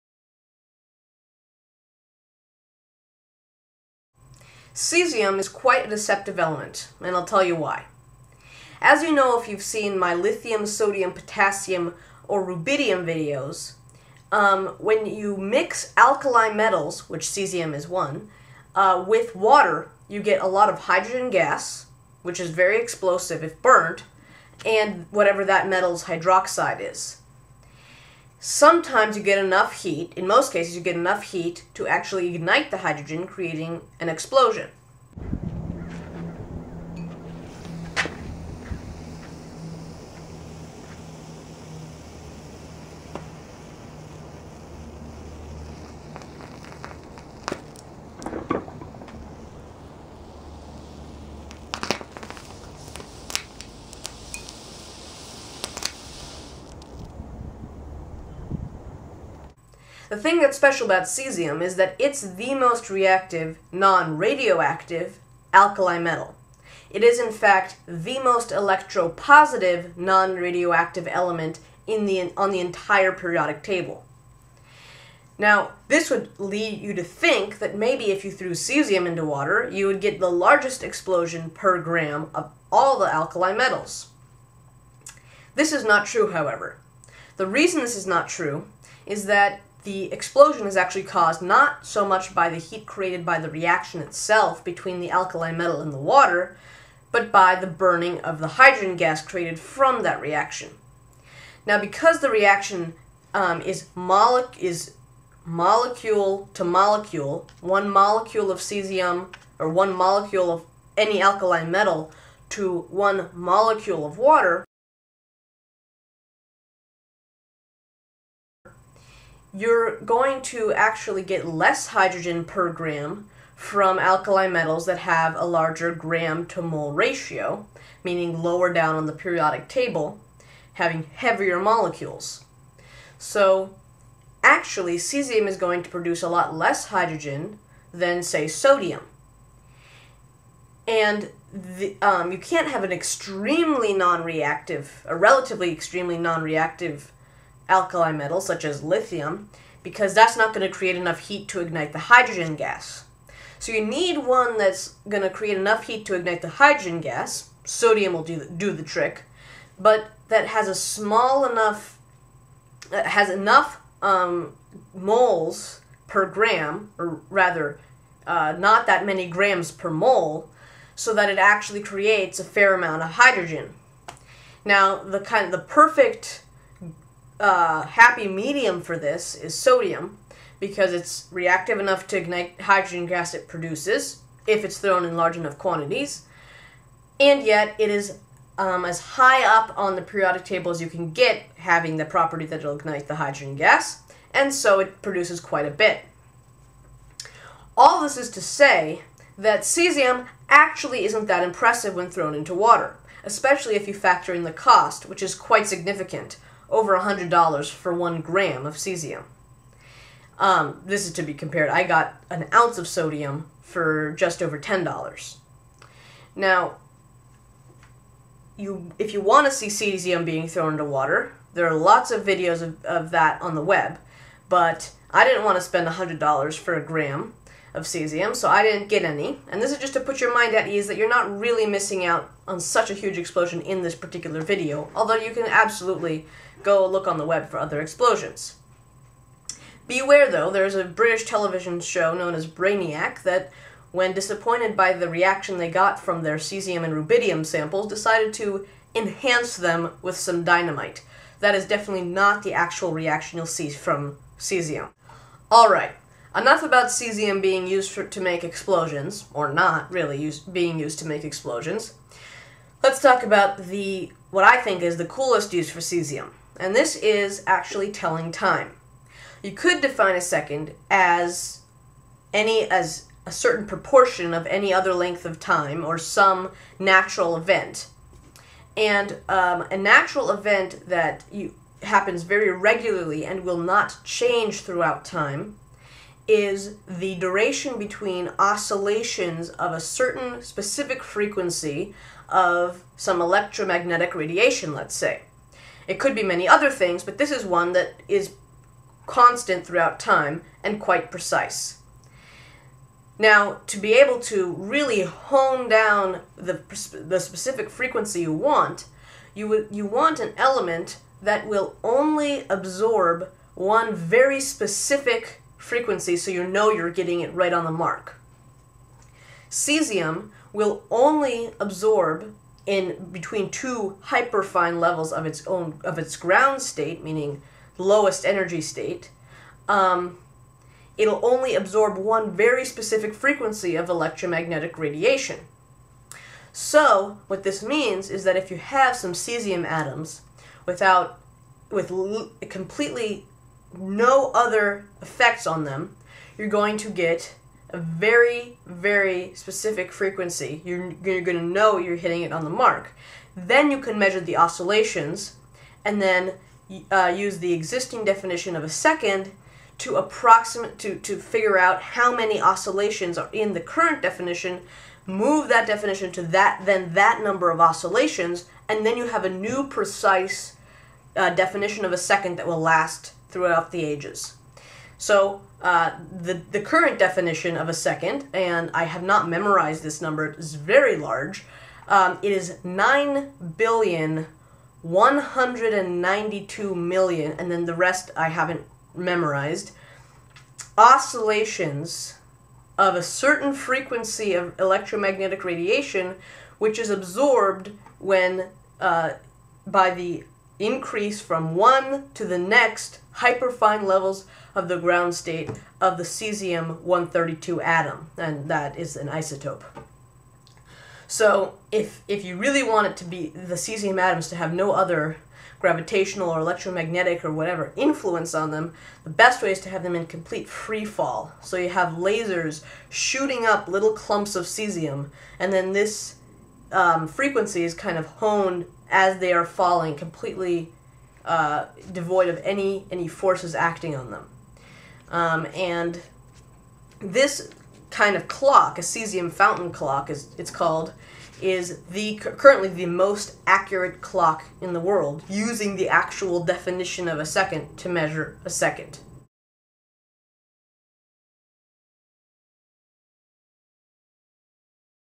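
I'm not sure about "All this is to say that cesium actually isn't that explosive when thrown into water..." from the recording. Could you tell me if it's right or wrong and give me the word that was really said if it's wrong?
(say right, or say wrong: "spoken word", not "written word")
wrong: "impressive", not "explosive".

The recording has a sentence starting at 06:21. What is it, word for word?
Um, it is 9 billion 192 million, and then the rest I haven't memorized.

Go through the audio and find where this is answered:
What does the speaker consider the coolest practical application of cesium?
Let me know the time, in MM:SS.
04:27.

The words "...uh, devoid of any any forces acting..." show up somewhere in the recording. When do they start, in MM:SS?
07:11.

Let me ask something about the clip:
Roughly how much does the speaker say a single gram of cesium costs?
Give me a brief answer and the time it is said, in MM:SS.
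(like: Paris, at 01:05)
over $100, at 03:26.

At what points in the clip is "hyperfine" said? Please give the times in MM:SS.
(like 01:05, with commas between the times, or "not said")
05:24, 06:43.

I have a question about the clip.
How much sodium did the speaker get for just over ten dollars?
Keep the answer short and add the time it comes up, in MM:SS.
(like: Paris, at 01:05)
an ounce, at 03:32.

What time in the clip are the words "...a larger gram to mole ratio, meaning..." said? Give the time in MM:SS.
02:05.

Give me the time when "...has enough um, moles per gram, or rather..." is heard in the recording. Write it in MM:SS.
02:43.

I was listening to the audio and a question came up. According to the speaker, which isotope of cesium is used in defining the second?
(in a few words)
cesium 132.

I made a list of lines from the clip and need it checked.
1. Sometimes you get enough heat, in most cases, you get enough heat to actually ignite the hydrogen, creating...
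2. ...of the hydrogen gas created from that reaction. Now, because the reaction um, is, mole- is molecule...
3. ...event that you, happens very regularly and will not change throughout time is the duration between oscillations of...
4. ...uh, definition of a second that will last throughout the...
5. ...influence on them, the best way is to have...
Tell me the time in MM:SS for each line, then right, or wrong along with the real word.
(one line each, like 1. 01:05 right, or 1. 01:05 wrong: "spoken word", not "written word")
1. 00:28 right
2. 01:38 right
3. 04:40 right
4. 06:11 right
5. 06:57 right.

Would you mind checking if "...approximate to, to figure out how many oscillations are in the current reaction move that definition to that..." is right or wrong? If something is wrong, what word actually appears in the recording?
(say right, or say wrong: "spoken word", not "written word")
wrong: "definition", not "reaction".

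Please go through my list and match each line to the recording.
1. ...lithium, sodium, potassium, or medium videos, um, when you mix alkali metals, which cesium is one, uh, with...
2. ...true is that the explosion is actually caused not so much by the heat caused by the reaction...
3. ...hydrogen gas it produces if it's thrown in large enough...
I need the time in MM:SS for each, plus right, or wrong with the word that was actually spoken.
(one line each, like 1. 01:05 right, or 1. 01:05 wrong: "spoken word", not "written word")
1. 00:10 wrong: "rubidium", not "medium"
2. 01:28 wrong: "created", not "caused"
3. 03:02 right.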